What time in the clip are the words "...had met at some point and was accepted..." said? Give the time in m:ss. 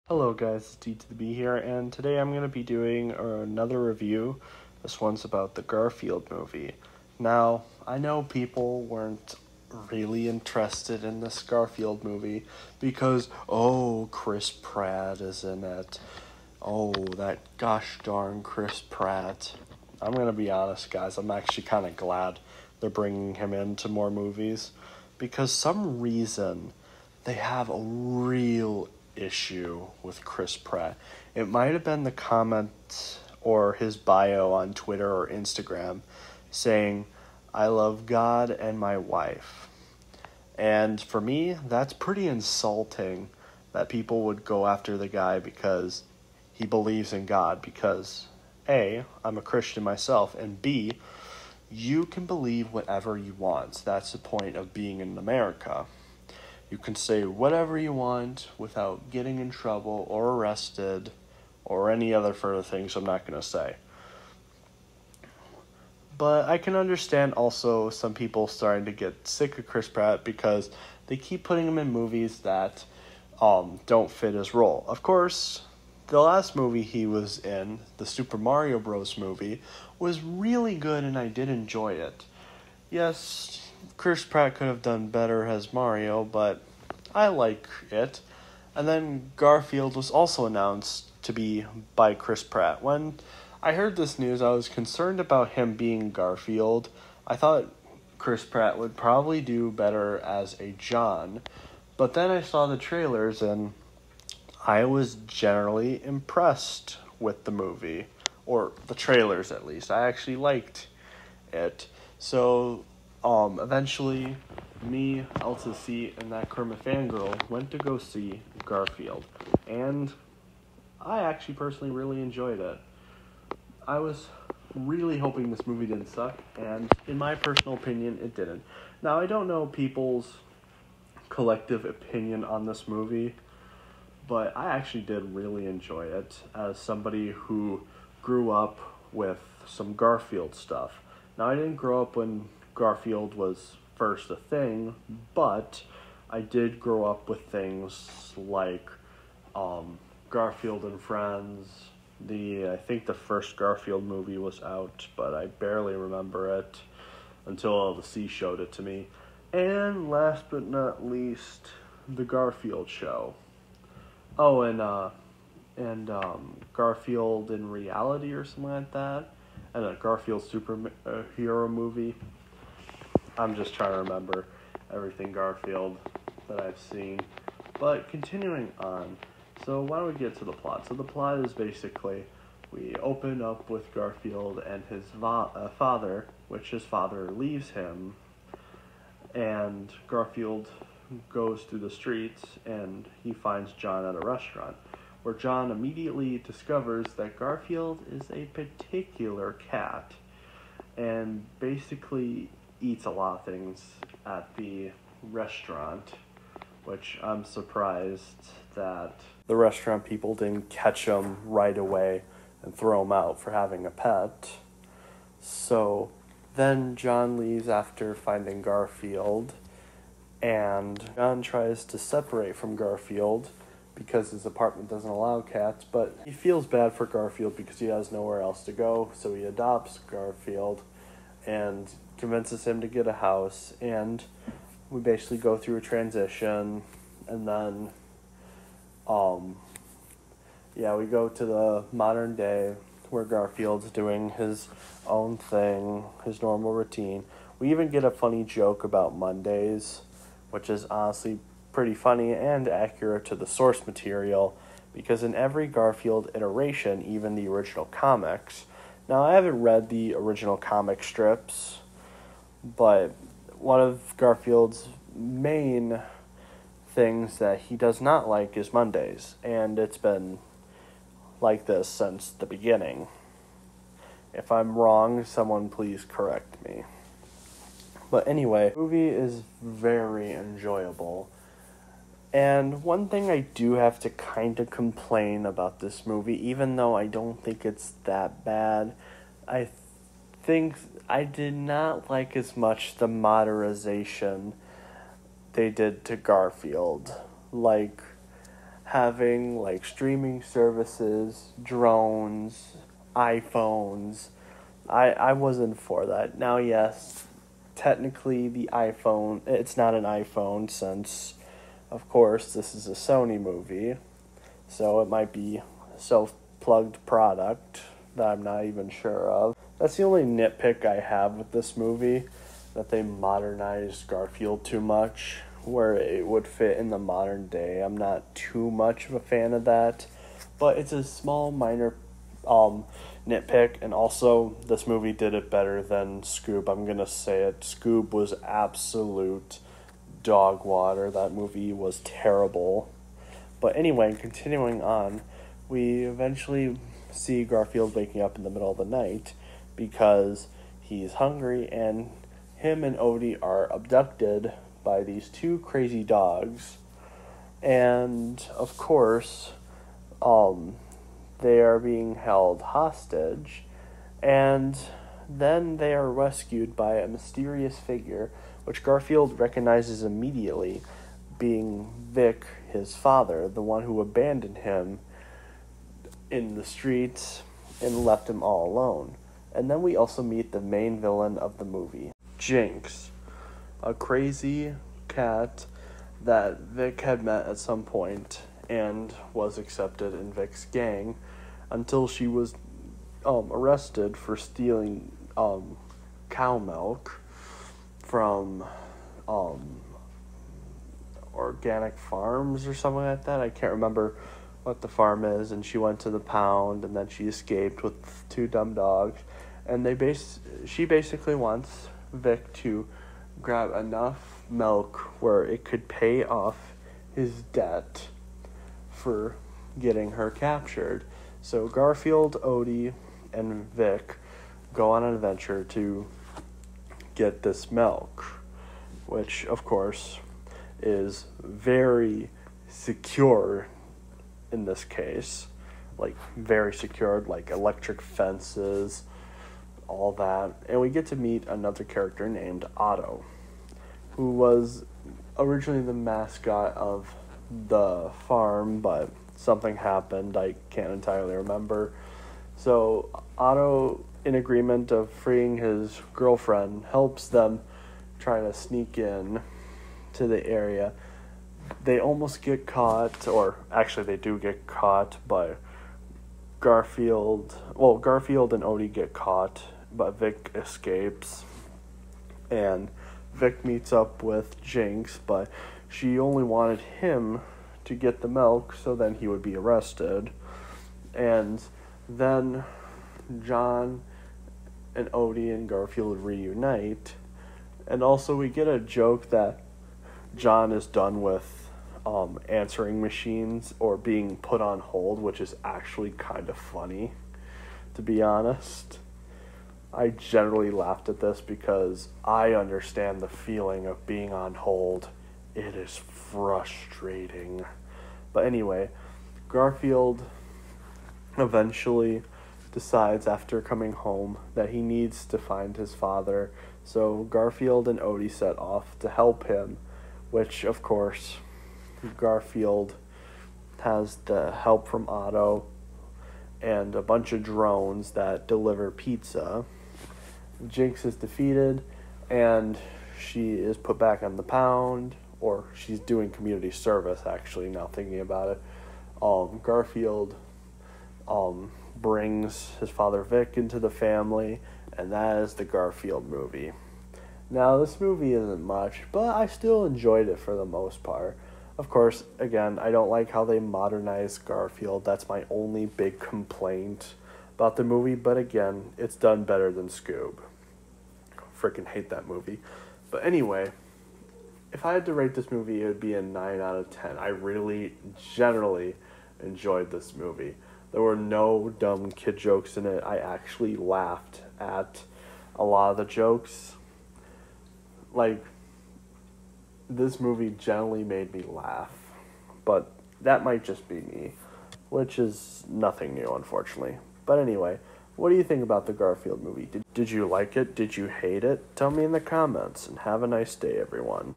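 6:27.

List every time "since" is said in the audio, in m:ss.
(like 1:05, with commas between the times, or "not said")
4:31, 5:10.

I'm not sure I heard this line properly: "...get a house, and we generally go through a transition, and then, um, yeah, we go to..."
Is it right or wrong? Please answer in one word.
wrong.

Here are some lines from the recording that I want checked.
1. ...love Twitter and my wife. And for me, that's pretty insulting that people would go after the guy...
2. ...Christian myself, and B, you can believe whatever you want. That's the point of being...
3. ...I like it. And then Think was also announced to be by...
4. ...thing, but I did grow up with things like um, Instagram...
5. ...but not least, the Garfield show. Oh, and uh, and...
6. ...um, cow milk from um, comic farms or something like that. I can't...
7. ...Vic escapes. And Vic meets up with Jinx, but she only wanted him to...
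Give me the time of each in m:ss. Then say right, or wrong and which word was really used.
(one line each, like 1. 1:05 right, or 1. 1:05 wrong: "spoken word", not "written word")
1. 0:37 wrong: "God", not "Twitter"
2. 0:49 right
3. 1:27 wrong: "Garfield", not "Think"
4. 2:24 wrong: "Garfield", not "Instagram"
5. 2:40 right
6. 6:35 wrong: "organic", not "comic"
7. 7:50 right.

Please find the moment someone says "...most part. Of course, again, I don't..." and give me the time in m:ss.
9:10.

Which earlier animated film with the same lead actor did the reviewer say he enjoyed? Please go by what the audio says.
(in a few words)
Super Mario Bros. movie.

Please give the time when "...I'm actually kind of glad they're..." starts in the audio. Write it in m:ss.
0:21.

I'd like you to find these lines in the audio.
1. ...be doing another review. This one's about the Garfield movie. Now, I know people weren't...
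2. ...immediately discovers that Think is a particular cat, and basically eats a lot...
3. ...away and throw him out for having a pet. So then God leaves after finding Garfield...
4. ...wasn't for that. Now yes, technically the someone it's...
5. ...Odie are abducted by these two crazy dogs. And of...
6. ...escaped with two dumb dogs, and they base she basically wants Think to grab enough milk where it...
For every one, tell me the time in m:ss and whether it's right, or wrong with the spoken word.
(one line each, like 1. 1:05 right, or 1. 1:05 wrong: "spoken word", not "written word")
1. 0:02 right
2. 3:15 wrong: "Garfield", not "Think"
3. 3:31 wrong: "John", not "God"
4. 5:05 wrong: "iPhone", not "someone"
5. 5:52 right
6. 6:47 wrong: "Vic", not "Think".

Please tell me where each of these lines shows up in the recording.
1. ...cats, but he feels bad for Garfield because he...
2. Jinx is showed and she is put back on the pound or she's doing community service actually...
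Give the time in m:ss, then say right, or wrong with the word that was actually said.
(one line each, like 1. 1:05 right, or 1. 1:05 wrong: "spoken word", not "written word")
1. 3:45 right
2. 8:50 wrong: "defeated", not "showed".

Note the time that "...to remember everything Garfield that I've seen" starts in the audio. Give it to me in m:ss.
2:53.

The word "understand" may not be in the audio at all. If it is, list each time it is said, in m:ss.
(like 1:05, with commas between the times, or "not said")
1:06, 8:22.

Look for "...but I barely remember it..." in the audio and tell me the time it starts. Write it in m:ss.
2:35.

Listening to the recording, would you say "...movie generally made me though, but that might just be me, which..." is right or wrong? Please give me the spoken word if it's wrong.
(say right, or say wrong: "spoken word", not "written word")
wrong: "laugh", not "though".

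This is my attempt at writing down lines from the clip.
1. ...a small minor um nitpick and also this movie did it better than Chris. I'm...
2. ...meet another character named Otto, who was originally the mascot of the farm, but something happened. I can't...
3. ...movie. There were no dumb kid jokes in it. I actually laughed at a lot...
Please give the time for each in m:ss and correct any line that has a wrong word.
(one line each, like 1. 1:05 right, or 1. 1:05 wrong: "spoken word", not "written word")
1. 5:30 wrong: "Scoob", not "Chris"
2. 7:21 right
3. 9:30 right.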